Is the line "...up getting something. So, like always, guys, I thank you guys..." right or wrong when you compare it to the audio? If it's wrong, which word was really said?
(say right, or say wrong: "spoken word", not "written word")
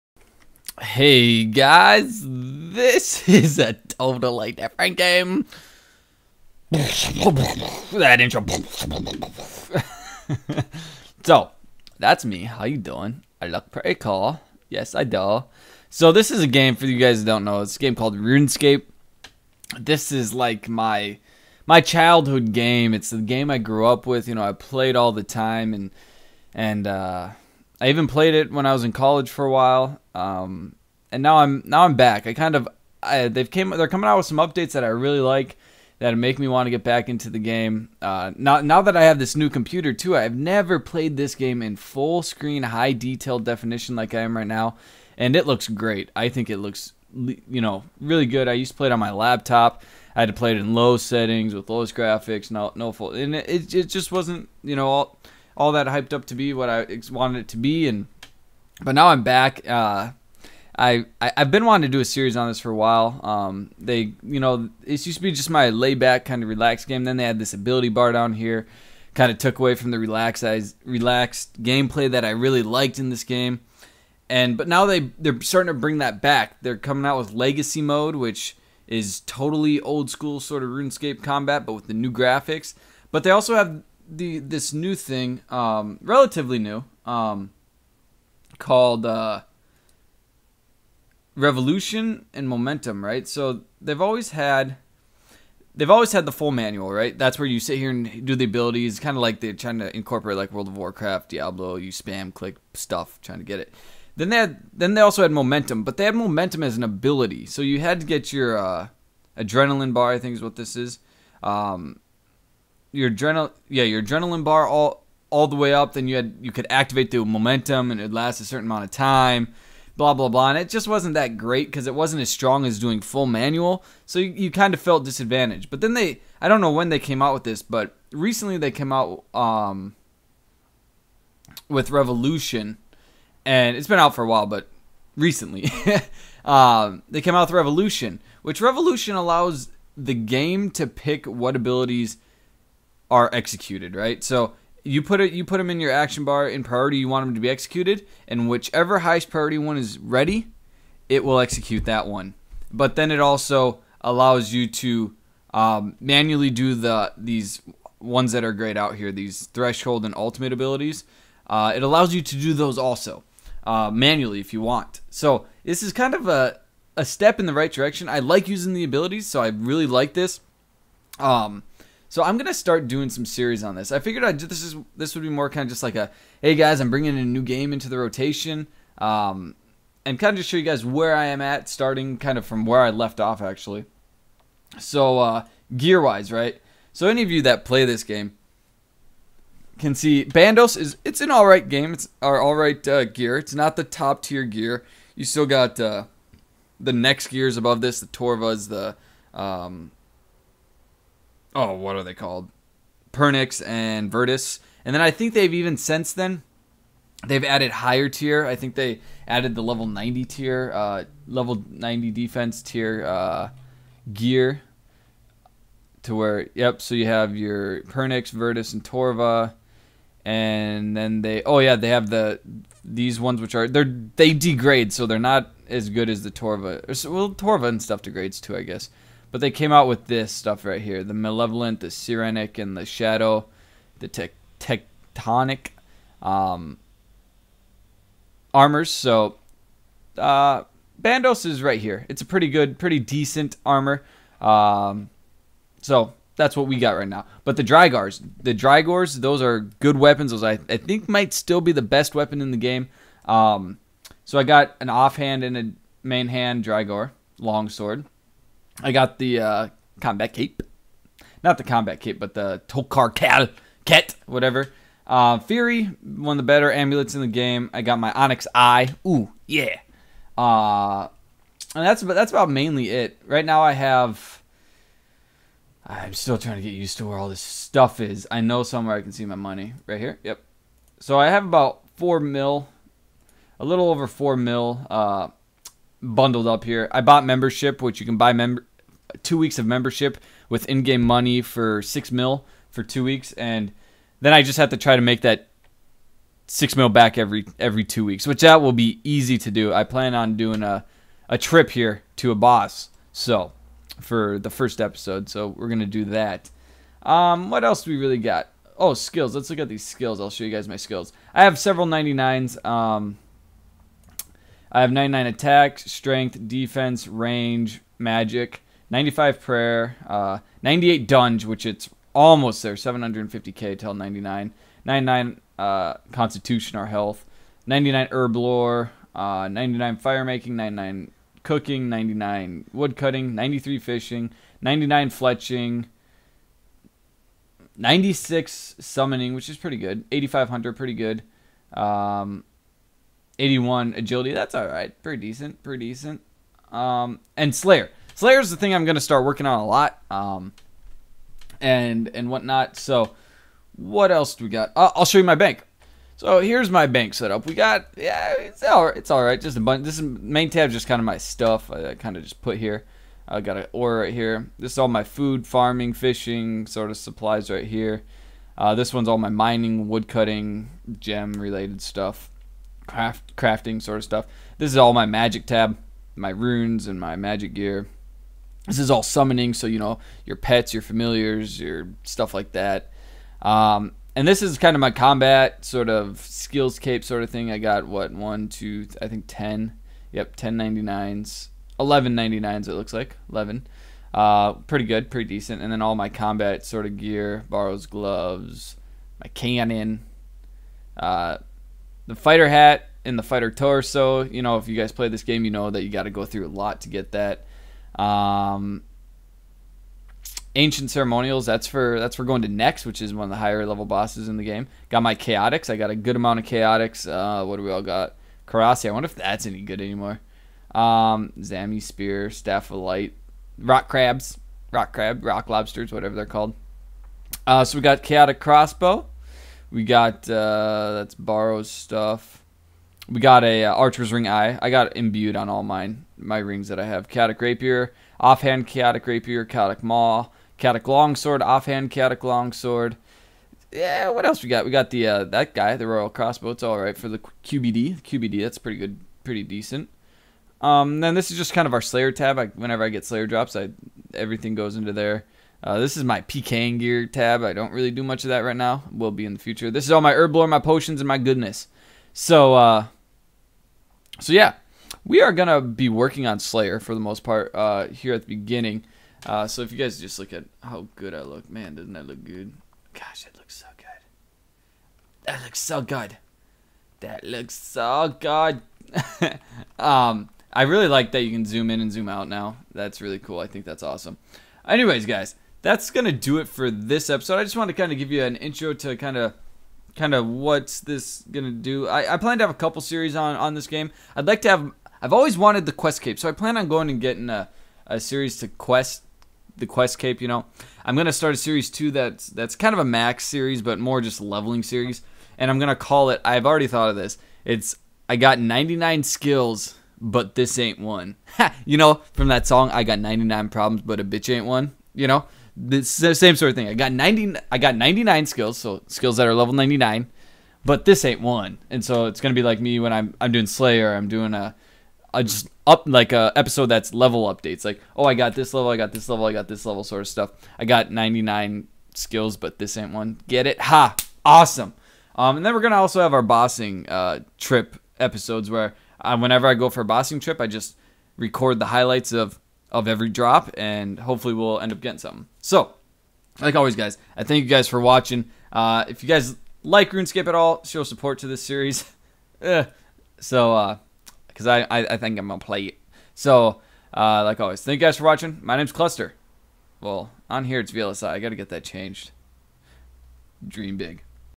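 right.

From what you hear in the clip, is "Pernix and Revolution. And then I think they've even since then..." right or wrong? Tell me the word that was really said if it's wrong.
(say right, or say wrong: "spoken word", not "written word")
wrong: "Virtus", not "Revolution".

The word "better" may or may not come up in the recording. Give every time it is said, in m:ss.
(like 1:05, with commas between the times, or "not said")
4:26.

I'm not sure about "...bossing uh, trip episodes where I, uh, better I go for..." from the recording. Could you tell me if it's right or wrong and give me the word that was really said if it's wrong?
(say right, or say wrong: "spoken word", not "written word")
wrong: "whenever", not "better".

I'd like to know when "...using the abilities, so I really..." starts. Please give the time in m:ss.
2:48.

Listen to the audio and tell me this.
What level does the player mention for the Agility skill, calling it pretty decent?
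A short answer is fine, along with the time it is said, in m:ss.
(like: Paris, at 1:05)
81, at 5:43.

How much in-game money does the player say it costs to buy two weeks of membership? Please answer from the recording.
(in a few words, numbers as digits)
6 mil.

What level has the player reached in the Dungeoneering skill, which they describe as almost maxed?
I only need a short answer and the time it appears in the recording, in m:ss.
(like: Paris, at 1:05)
98, at 5:20.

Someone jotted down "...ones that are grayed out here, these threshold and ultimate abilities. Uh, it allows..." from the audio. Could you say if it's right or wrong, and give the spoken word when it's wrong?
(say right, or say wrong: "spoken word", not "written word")
right.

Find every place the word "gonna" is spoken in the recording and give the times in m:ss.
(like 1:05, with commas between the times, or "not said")
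2:52, 5:05, 7:45, 8:05, 8:11, 8:20, 8:25.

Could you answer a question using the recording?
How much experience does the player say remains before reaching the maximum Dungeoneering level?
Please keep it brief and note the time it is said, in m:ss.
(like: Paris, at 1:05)
750k, at 5:22.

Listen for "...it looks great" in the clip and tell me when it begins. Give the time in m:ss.
0:45.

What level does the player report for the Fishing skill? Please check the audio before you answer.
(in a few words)
93.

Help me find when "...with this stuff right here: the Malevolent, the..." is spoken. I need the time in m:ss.
3:49.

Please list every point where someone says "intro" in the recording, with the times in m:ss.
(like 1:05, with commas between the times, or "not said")
0:08, 8:08.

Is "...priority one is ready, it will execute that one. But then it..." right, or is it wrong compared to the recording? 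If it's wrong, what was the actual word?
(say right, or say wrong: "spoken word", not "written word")
right.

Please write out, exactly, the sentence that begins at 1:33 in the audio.
So they've always had they've always had the full manual, right?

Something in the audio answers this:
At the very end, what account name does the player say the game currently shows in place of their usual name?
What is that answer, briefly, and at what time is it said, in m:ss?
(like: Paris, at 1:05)
VLSI, at 9:20.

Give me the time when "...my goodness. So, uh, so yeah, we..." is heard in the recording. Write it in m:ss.
7:41.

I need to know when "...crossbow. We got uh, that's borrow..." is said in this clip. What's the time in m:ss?
7:08.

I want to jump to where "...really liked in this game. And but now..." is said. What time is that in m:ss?
1:12.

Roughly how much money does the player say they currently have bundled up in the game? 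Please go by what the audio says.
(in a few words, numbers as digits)
a little over 4 mil.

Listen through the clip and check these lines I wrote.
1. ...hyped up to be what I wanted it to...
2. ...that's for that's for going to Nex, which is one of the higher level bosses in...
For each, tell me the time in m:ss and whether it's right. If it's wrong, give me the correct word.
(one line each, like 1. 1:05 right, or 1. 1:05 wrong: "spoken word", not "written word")
1. 0:55 right
2. 6:51 right.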